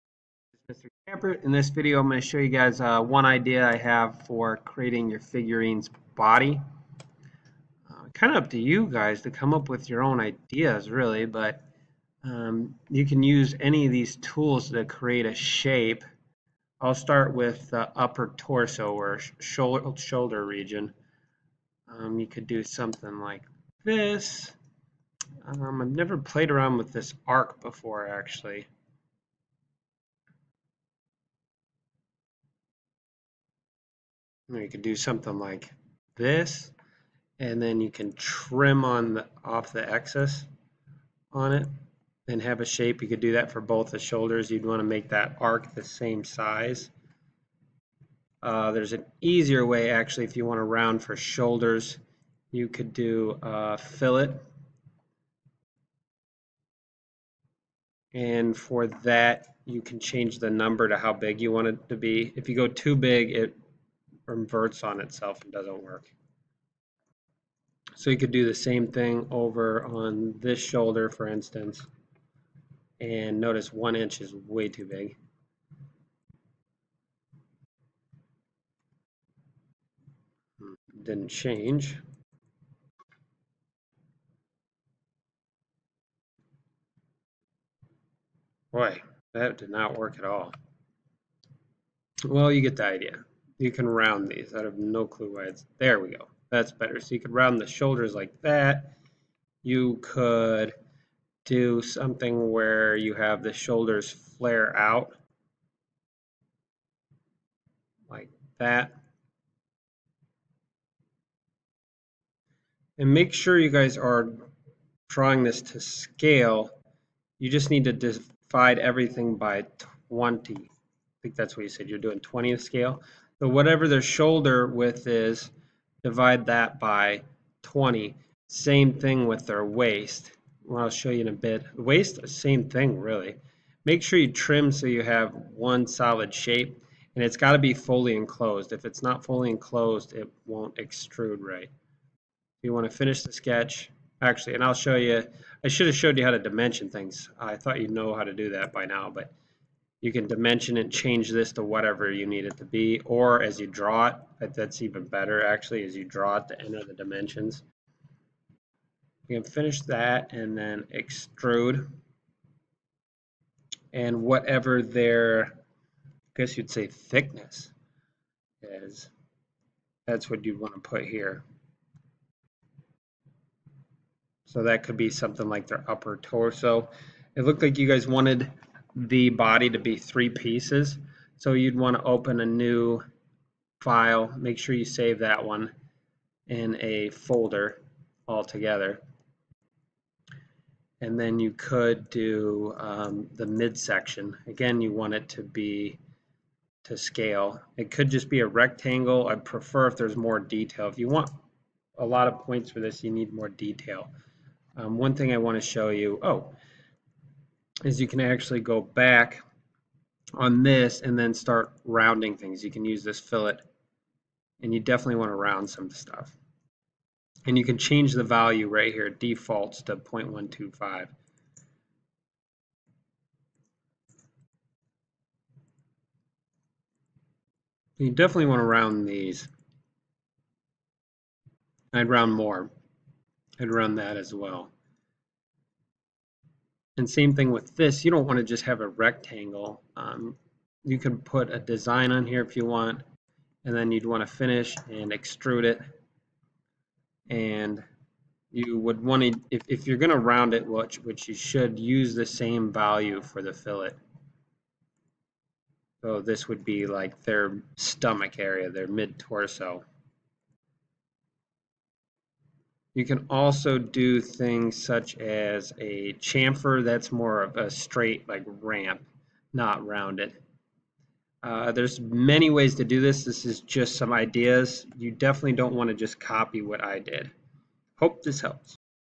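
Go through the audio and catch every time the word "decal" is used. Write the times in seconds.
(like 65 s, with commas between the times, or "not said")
not said.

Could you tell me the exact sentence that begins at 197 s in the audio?
It could just be a rectangle.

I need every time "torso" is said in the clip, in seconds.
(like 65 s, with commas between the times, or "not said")
18 s, 176 s, 258 s.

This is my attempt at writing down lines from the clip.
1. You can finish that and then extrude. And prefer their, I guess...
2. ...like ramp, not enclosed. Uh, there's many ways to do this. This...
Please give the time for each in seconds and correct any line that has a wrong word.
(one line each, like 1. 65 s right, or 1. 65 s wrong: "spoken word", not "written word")
1. 159 s wrong: "whatever", not "prefer"
2. 268 s wrong: "rounded", not "enclosed".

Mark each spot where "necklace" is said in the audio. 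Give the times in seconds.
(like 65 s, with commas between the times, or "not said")
not said.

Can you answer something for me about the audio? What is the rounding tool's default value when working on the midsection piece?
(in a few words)
0.125.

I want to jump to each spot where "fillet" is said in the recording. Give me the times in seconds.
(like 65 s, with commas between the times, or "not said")
53 s, 213 s, 253 s.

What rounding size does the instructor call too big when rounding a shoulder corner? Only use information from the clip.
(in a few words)
1 inch.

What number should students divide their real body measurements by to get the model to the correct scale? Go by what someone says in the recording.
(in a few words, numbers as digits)
20.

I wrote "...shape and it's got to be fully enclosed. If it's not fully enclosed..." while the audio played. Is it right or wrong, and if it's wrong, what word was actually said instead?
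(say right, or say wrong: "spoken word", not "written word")
right.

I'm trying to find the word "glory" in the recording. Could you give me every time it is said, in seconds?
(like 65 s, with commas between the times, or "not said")
not said.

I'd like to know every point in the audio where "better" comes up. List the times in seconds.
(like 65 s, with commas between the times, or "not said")
96 s, 155 s.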